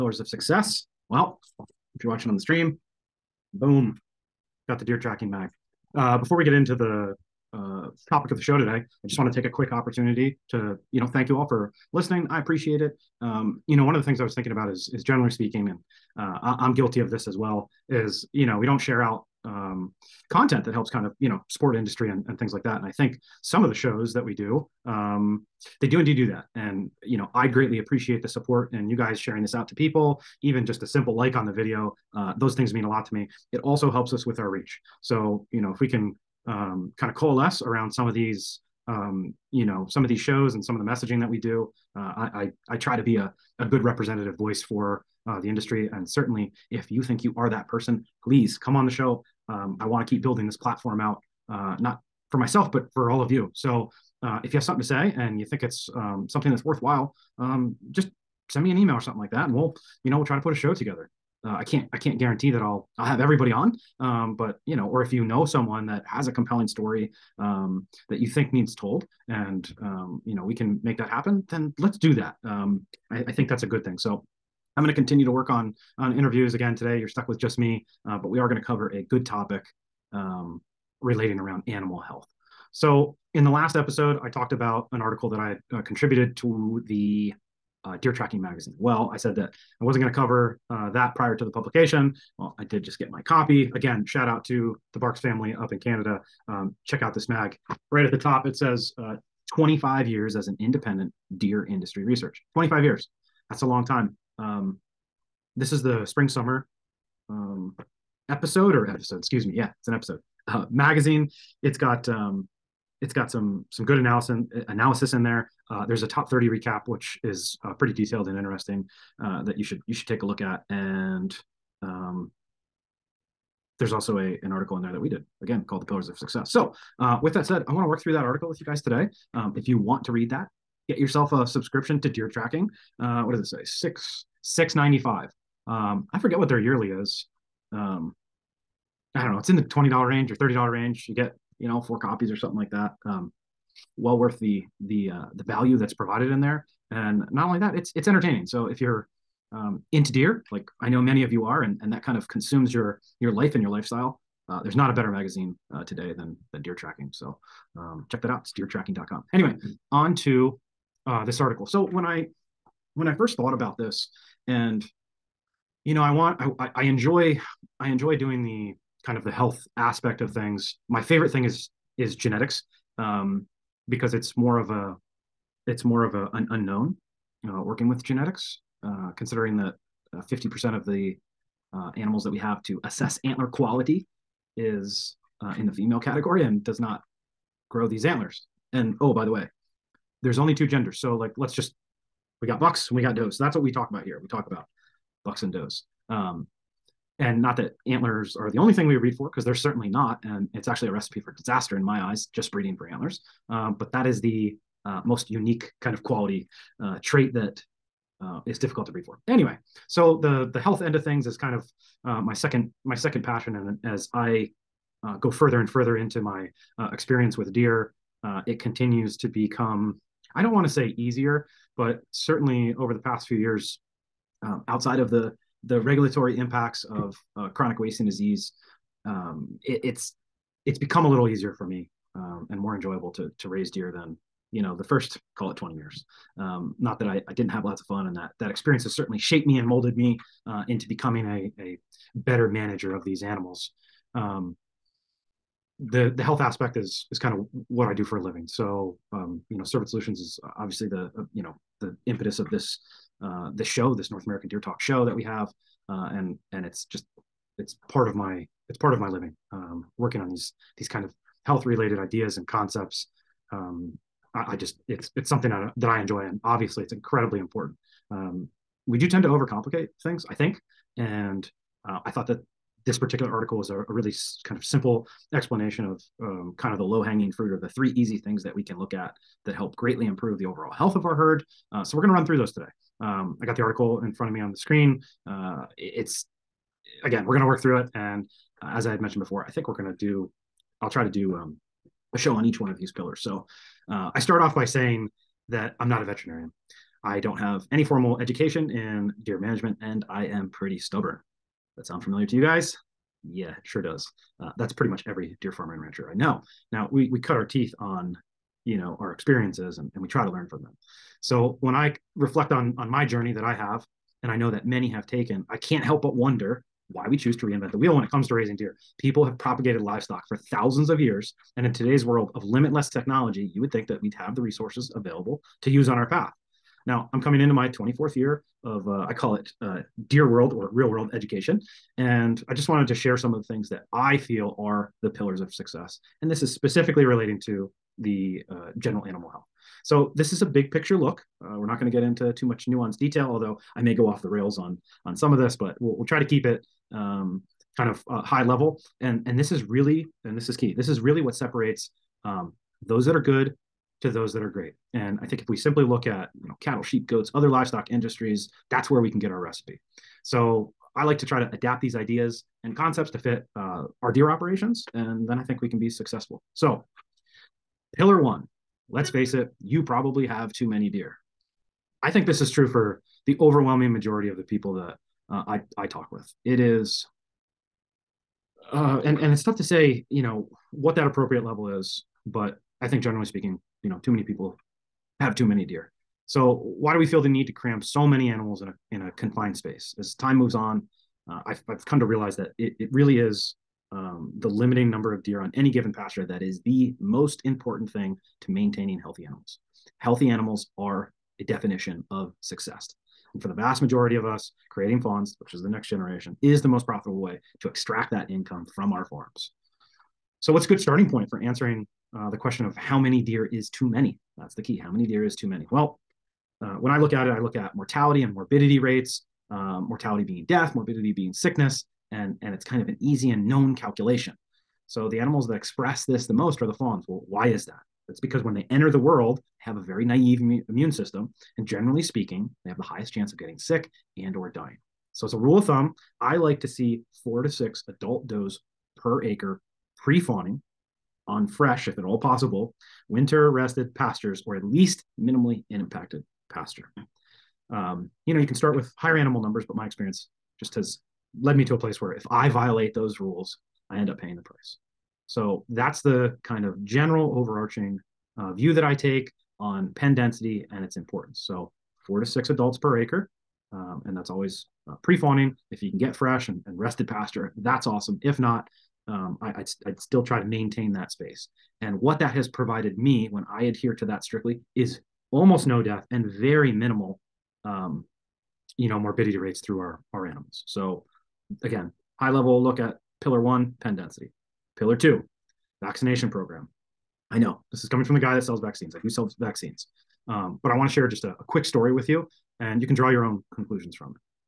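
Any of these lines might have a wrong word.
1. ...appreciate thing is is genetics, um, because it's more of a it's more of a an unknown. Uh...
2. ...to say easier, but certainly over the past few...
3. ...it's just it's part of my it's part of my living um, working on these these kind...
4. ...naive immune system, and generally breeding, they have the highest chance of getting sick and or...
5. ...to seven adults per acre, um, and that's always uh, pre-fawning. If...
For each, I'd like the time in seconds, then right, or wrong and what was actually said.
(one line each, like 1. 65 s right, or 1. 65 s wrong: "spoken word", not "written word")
1. 170 s wrong: "favorite", not "appreciate"
2. 220 s right
3. 256 s right
4. 430 s wrong: "speaking", not "breeding"
5. 462 s wrong: "six", not "seven".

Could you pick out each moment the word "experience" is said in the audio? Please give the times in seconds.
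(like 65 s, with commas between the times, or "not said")
216 s, 238 s, 309 s, 449 s.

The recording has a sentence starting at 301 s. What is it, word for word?
That sound familiar to you guys?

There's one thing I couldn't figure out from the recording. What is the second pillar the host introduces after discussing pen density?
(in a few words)
Vaccination program.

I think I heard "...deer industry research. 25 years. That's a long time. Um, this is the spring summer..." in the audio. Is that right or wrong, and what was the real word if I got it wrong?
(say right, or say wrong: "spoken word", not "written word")
right.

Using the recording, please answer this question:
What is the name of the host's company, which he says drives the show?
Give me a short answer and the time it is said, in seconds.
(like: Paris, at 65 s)
Cervid Solutions, at 249 s.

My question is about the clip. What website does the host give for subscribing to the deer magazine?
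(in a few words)
deertracking.com.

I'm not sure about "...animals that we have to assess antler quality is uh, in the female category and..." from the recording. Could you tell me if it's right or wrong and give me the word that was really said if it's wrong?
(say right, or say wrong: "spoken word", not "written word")
right.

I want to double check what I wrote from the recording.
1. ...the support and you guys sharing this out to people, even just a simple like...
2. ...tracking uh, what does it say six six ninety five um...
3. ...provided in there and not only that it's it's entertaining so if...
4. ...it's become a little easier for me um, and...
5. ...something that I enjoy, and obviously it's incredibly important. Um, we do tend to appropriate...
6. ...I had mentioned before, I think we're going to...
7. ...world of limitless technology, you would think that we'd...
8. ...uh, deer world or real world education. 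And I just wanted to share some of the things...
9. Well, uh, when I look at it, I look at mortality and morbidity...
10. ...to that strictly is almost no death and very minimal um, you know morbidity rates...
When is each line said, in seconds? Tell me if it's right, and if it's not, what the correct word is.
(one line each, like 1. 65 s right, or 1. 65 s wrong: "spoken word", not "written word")
1. 28 s right
2. 132 s right
3. 145 s right
4. 230 s right
5. 265 s wrong: "overcomplicate", not "appropriate"
6. 288 s right
7. 322 s right
8. 329 s right
9. 415 s right
10. 473 s right.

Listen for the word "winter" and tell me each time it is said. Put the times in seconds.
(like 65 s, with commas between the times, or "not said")
443 s.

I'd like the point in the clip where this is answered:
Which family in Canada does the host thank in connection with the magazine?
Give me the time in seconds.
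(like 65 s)
94 s.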